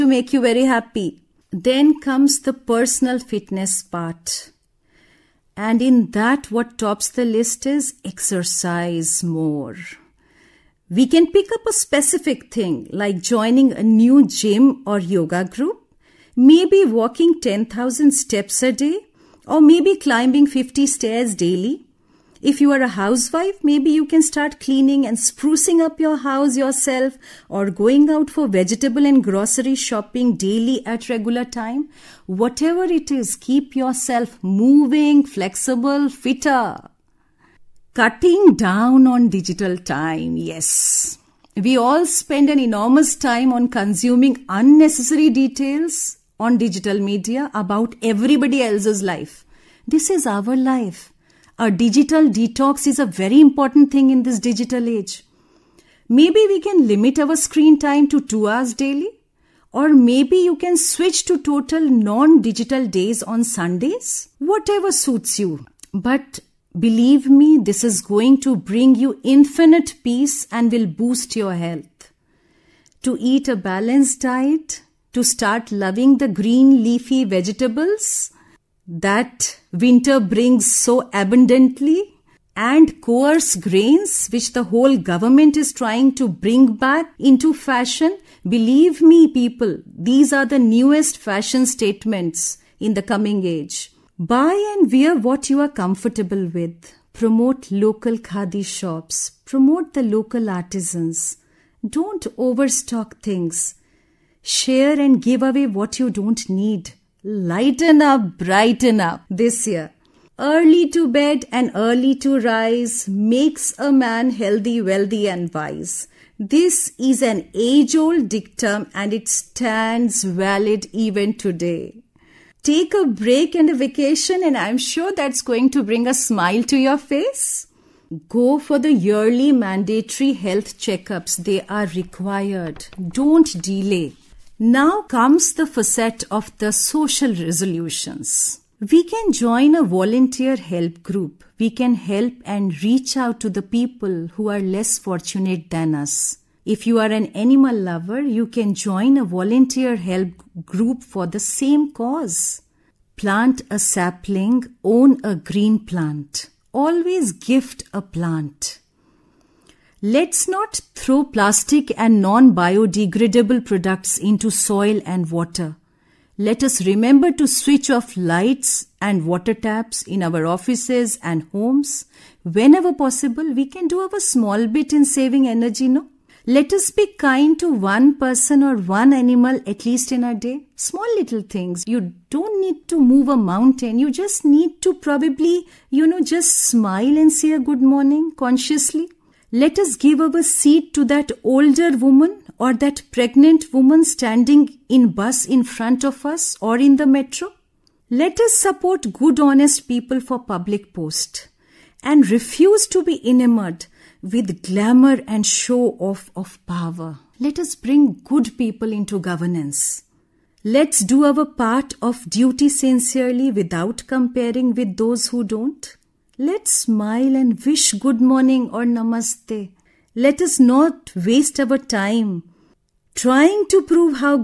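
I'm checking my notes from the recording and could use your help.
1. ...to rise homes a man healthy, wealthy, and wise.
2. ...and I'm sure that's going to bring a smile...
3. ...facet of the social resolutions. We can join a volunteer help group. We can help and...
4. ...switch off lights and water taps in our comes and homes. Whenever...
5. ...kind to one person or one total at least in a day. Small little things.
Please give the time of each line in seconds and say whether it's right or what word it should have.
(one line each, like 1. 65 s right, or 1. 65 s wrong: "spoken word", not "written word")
1. 112 s wrong: "makes", not "homes"
2. 124 s right
3. 135 s right
4. 167 s wrong: "offices", not "comes"
5. 177 s wrong: "animal", not "total".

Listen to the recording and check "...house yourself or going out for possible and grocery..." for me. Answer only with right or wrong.
wrong.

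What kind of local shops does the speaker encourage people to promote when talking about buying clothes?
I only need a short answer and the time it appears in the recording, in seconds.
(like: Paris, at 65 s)
Khadi shops, at 98 s.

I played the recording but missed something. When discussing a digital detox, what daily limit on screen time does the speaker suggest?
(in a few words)
2 hours.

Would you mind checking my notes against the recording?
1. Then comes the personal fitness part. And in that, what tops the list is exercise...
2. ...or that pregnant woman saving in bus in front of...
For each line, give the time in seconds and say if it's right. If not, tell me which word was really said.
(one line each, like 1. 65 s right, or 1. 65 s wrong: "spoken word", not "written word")
1. 1 s right
2. 192 s wrong: "standing", not "saving".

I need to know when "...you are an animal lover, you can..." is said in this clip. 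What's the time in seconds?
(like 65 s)
146 s.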